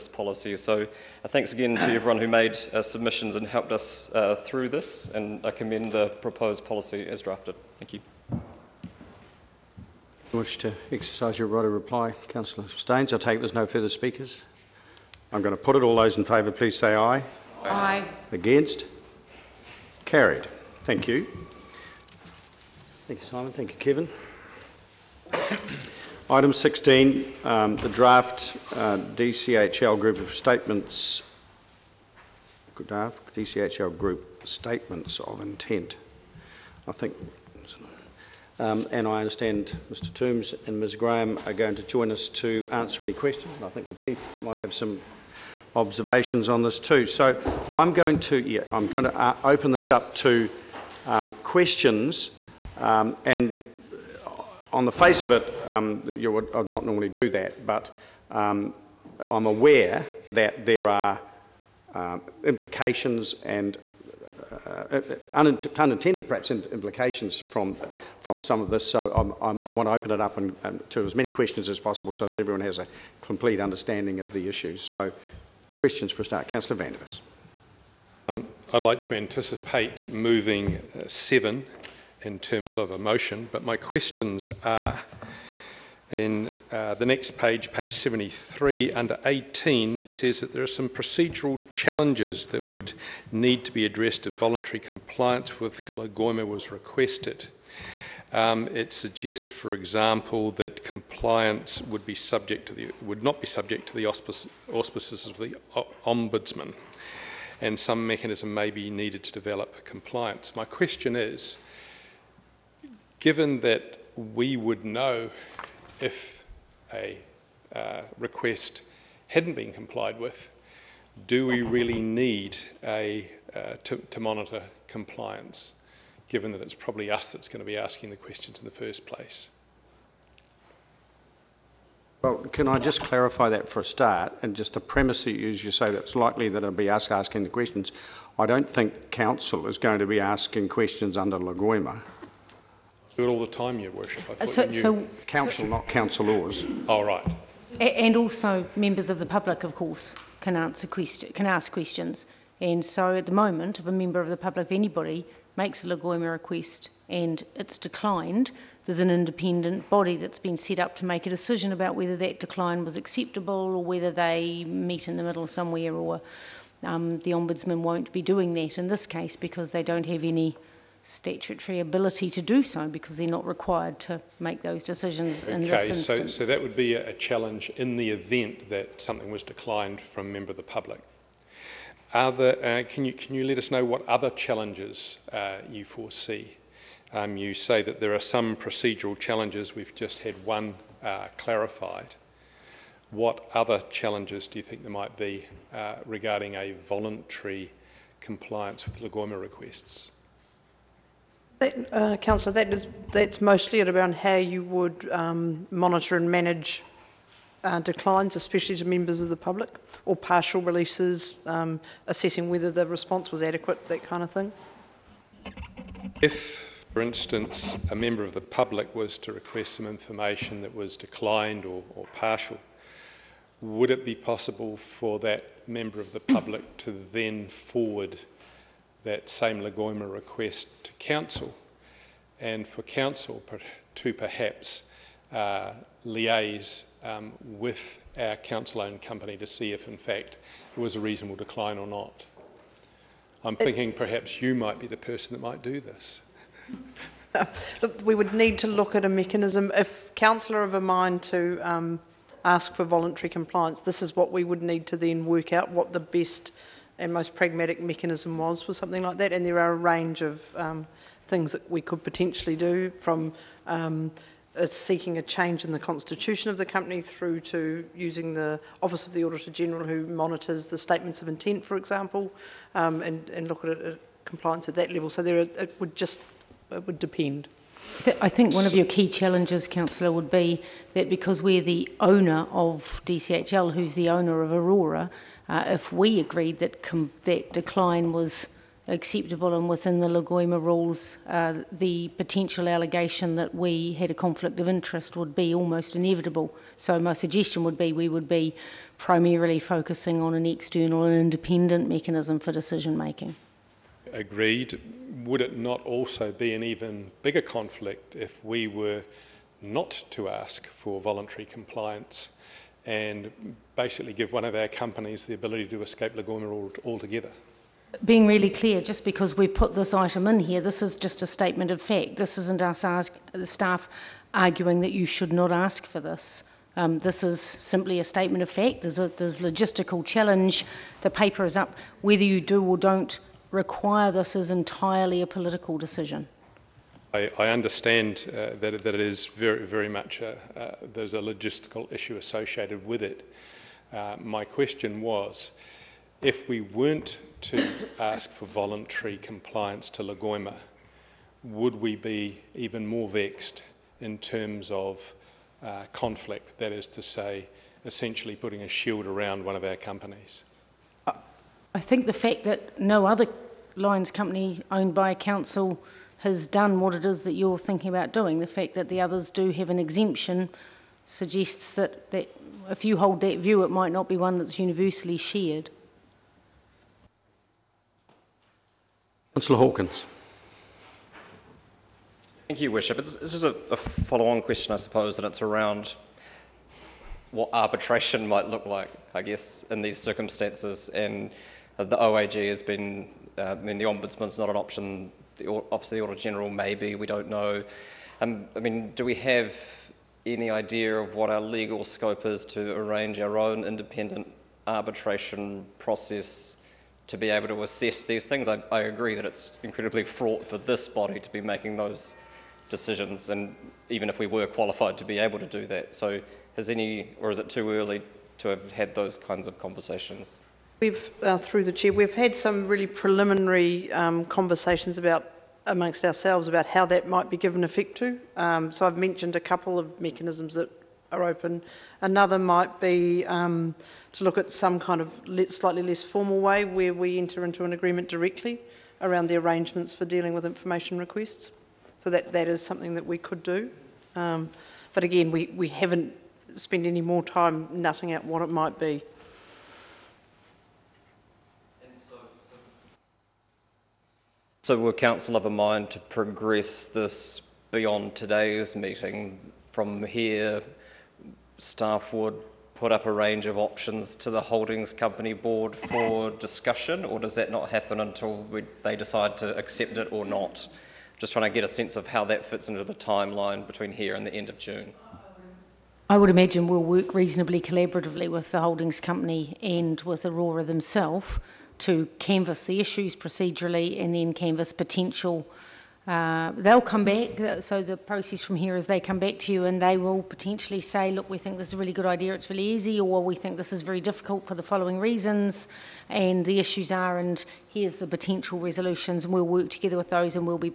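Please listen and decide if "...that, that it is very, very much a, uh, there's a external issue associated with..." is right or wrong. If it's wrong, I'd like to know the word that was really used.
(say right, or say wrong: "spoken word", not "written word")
wrong: "logistical", not "external".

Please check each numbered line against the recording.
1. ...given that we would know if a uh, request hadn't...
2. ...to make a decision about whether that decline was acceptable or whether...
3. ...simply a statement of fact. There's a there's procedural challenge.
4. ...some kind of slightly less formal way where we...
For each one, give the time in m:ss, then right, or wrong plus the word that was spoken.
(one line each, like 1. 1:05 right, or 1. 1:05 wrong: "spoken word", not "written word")
1. 1:53 right
2. 2:40 right
3. 5:27 wrong: "logistical", not "procedural"
4. 7:14 right.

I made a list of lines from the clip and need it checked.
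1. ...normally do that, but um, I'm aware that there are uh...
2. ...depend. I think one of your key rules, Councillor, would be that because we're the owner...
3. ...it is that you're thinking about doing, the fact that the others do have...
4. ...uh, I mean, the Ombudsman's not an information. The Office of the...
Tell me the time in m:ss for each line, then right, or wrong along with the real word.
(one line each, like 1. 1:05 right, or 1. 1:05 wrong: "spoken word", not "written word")
1. 0:56 right
2. 4:36 wrong: "challenges", not "rules"
3. 6:06 right
4. 6:33 wrong: "option", not "information".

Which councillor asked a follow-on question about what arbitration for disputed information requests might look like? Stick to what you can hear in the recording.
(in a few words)
Councillor Hawkins.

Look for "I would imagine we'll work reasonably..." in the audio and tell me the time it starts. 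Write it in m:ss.
7:56.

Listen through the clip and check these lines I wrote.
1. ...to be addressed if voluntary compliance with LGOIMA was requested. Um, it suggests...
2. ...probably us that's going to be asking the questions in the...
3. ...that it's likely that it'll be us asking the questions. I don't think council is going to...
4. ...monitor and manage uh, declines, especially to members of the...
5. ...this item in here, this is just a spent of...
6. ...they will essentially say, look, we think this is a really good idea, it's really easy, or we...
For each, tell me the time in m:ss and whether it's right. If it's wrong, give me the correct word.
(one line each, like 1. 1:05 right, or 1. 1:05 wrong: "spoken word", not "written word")
1. 1:33 right
2. 2:06 right
3. 2:15 right
4. 3:25 right
5. 5:19 wrong: "statement", not "spent"
6. 8:09 wrong: "potentially", not "essentially".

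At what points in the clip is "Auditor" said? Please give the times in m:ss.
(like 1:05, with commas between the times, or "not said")
4:29, 6:36.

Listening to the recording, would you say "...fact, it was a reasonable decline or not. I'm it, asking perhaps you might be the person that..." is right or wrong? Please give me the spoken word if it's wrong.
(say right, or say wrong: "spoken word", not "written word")
wrong: "thinking", not "asking".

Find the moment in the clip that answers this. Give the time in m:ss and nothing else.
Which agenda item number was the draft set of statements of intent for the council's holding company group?
0:26.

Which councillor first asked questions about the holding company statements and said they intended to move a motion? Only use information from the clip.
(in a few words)
Councillor Vandervis.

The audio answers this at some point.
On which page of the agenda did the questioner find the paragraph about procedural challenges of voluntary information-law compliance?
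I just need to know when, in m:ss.
1:27.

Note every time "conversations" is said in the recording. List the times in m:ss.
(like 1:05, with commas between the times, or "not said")
6:59, 7:04.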